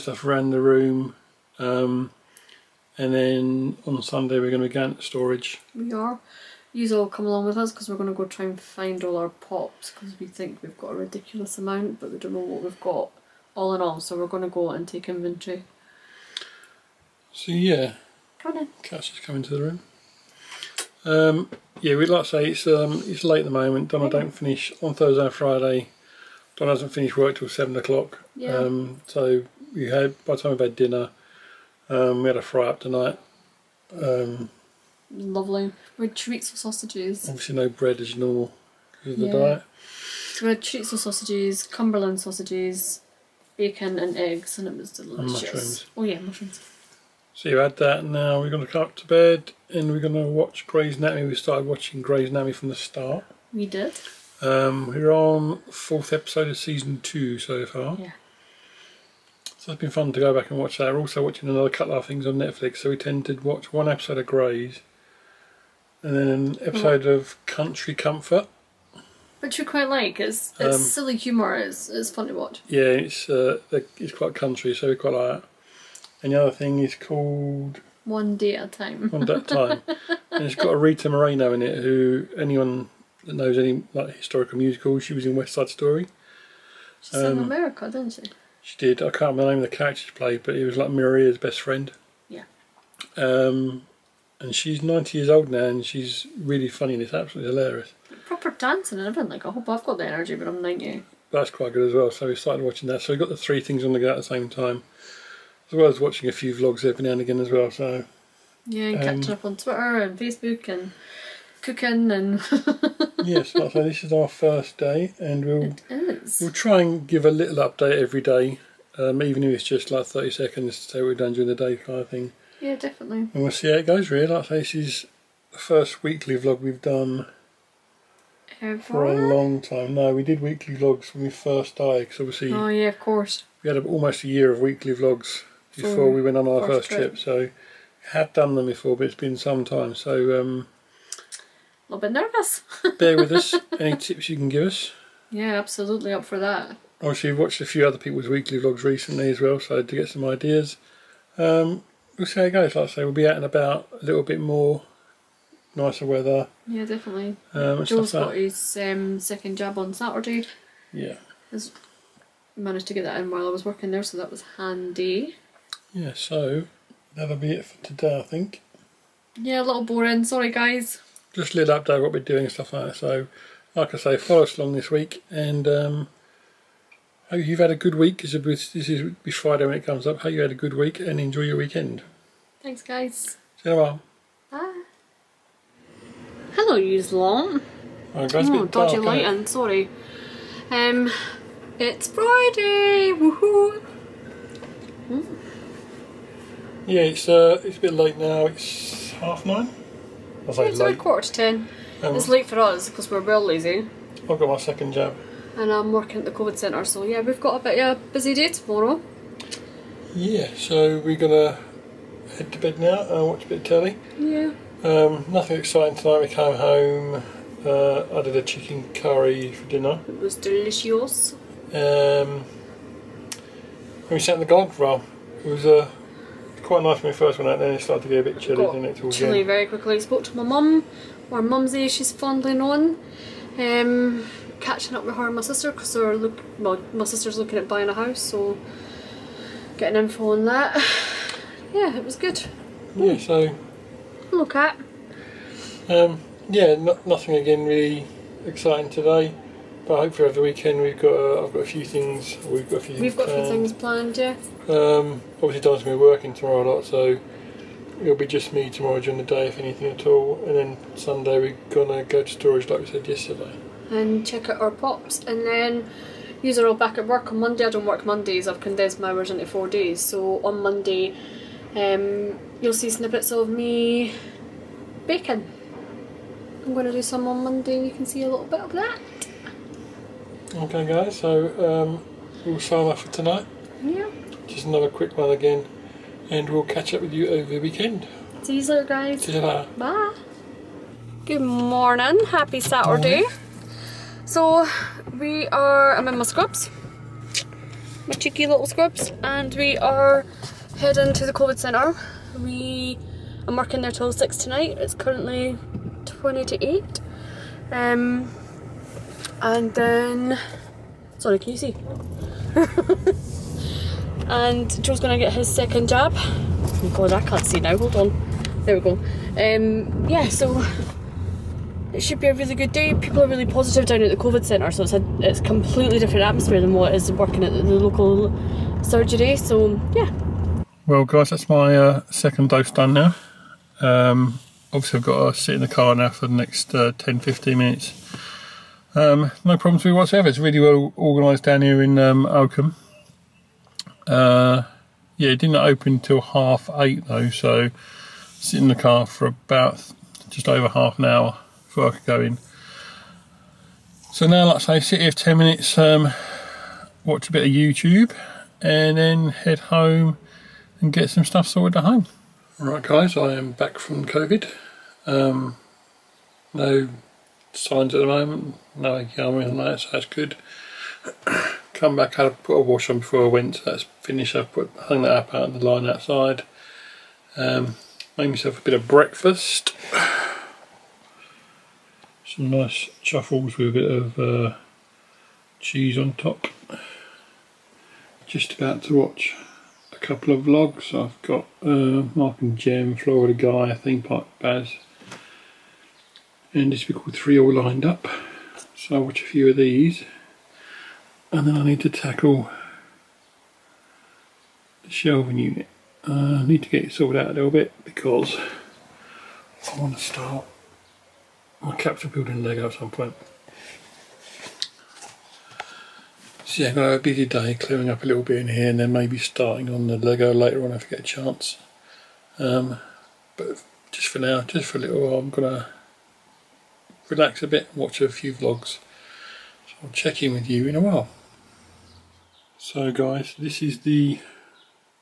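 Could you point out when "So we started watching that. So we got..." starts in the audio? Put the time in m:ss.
1:42.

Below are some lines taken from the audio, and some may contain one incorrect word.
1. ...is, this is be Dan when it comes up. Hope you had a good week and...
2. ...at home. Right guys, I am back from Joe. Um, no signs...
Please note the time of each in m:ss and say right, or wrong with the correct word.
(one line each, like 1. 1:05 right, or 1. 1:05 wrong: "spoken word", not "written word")
1. 2:58 wrong: "Friday", not "Dan"
2. 6:01 wrong: "COVID", not "Joe".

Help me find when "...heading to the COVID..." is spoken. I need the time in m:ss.
5:00.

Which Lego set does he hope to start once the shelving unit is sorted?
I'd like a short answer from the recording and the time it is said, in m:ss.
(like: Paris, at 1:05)
Capitol building, at 6:51.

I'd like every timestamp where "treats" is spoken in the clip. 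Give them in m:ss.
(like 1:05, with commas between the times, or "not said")
0:36, 0:40.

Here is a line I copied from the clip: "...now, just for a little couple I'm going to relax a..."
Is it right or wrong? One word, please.
wrong.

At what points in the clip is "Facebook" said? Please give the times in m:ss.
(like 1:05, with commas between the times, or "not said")
1:50.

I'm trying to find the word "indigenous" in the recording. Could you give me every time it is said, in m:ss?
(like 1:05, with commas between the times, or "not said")
not said.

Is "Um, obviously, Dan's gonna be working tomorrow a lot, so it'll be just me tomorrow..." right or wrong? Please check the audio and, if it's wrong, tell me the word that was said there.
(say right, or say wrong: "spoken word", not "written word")
right.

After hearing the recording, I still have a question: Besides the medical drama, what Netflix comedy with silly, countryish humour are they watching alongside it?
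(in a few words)
Country Comfort.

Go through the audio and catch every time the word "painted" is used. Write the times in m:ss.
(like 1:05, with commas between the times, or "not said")
not said.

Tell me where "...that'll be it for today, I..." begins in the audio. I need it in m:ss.
2:47.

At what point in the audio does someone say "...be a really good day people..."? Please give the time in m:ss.
5:22.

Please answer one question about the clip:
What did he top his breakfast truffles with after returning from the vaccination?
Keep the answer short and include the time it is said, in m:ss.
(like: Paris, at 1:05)
Cheese, at 6:25.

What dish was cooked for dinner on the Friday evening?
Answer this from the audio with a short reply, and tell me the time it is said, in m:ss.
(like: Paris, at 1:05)
Chicken curry, at 3:38.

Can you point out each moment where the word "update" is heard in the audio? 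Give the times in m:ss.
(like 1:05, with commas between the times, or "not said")
1:57, 2:51.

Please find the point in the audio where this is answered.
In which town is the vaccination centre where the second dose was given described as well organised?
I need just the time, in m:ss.
5:42.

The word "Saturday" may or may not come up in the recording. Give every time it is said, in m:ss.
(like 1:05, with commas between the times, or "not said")
2:39, 4:52.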